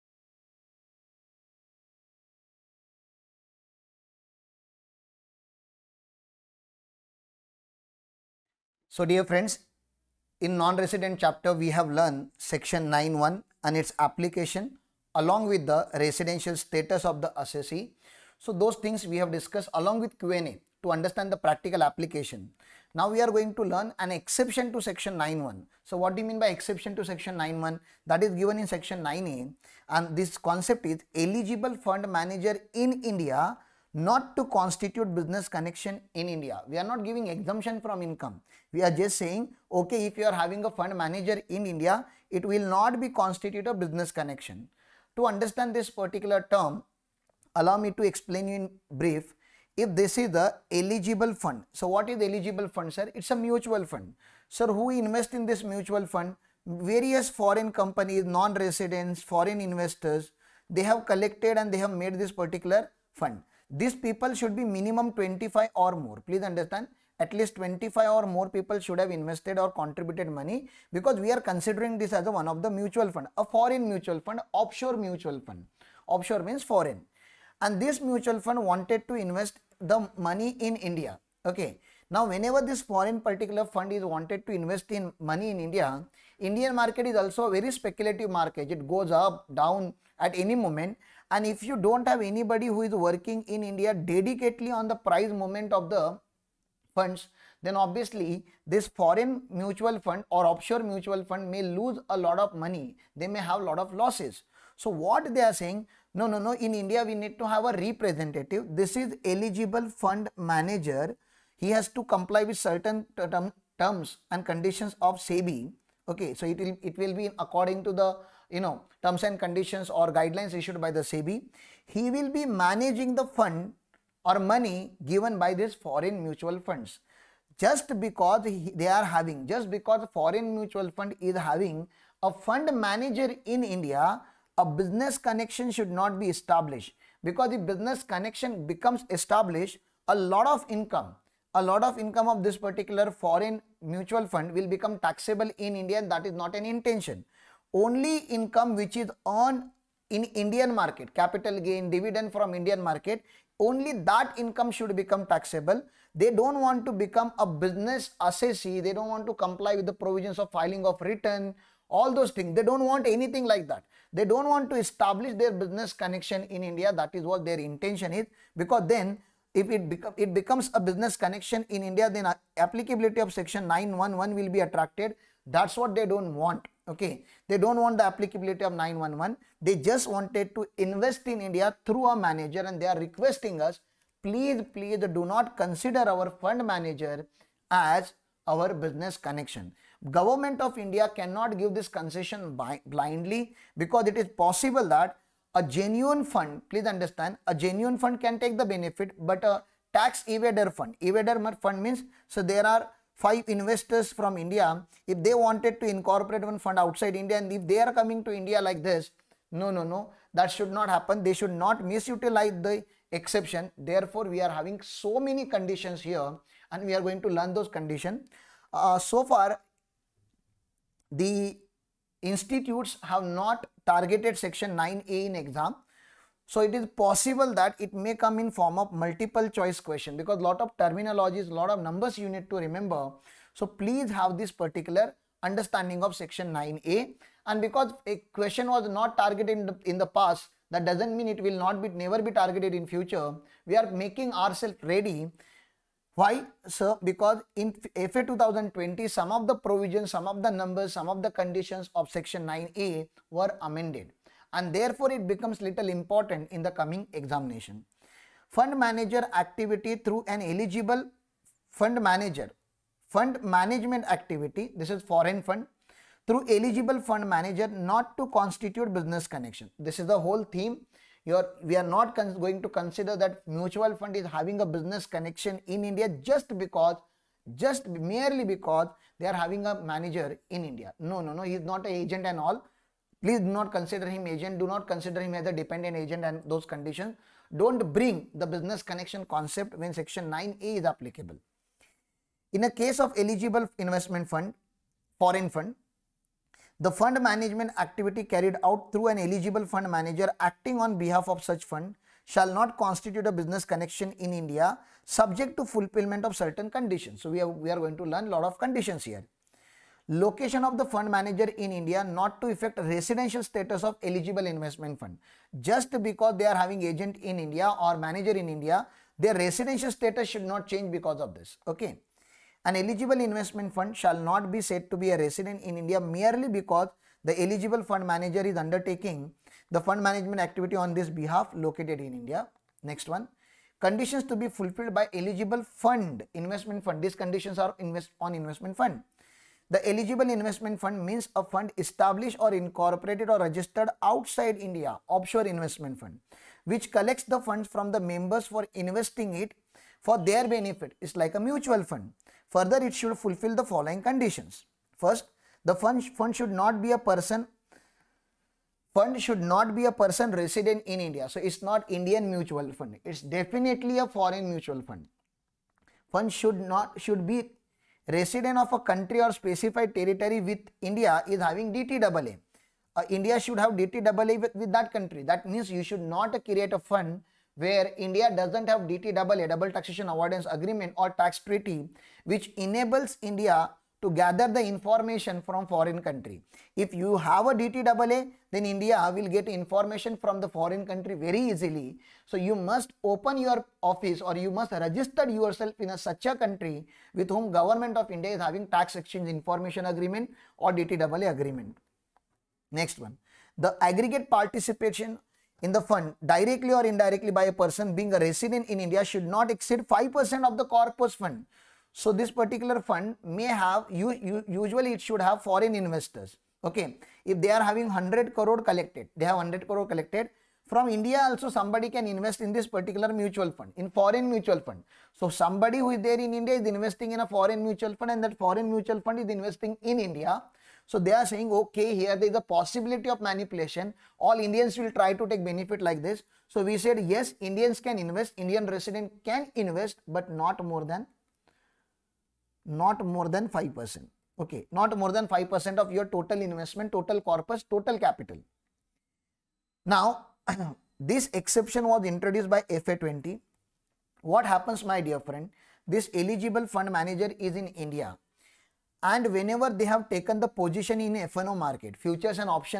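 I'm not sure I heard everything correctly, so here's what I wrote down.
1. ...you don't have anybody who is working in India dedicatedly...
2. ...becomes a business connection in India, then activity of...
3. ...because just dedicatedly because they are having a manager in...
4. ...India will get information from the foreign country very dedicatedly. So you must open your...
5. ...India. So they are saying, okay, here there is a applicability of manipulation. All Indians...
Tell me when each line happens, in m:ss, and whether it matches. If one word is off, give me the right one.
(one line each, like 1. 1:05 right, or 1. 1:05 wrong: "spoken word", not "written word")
1. 1:31 right
2. 2:50 wrong: "applicability", not "activity"
3. 4:36 wrong: "merely", not "dedicatedly"
4. 6:28 wrong: "easily", not "dedicatedly"
5. 7:09 wrong: "possibility", not "applicability".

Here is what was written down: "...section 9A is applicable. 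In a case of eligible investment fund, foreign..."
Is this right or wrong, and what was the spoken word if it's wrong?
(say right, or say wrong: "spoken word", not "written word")
right.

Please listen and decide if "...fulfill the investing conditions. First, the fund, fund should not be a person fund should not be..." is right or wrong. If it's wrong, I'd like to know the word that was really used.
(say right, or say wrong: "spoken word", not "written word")
wrong: "following", not "investing".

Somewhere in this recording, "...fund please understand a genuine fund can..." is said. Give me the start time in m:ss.
3:16.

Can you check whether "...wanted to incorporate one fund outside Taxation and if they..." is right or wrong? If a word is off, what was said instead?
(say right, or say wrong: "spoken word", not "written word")
wrong: "India", not "Taxation".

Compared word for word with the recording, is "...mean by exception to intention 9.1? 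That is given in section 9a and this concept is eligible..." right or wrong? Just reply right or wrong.
wrong.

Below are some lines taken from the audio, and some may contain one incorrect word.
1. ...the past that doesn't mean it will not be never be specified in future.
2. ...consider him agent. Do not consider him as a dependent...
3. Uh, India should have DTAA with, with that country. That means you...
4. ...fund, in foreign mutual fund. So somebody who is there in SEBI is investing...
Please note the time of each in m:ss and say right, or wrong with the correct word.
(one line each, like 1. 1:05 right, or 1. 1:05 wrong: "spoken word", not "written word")
1. 3:59 wrong: "targeted", not "specified"
2. 4:43 right
3. 6:12 right
4. 7:03 wrong: "India", not "SEBI".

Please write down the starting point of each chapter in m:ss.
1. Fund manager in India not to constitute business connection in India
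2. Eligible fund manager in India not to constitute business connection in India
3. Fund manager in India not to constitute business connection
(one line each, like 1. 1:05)
1. 2:28
2. 4:48
3. 0:10.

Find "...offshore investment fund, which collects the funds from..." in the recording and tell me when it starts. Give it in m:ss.
5:45.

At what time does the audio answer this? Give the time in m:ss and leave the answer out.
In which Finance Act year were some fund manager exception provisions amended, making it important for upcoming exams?
4:08.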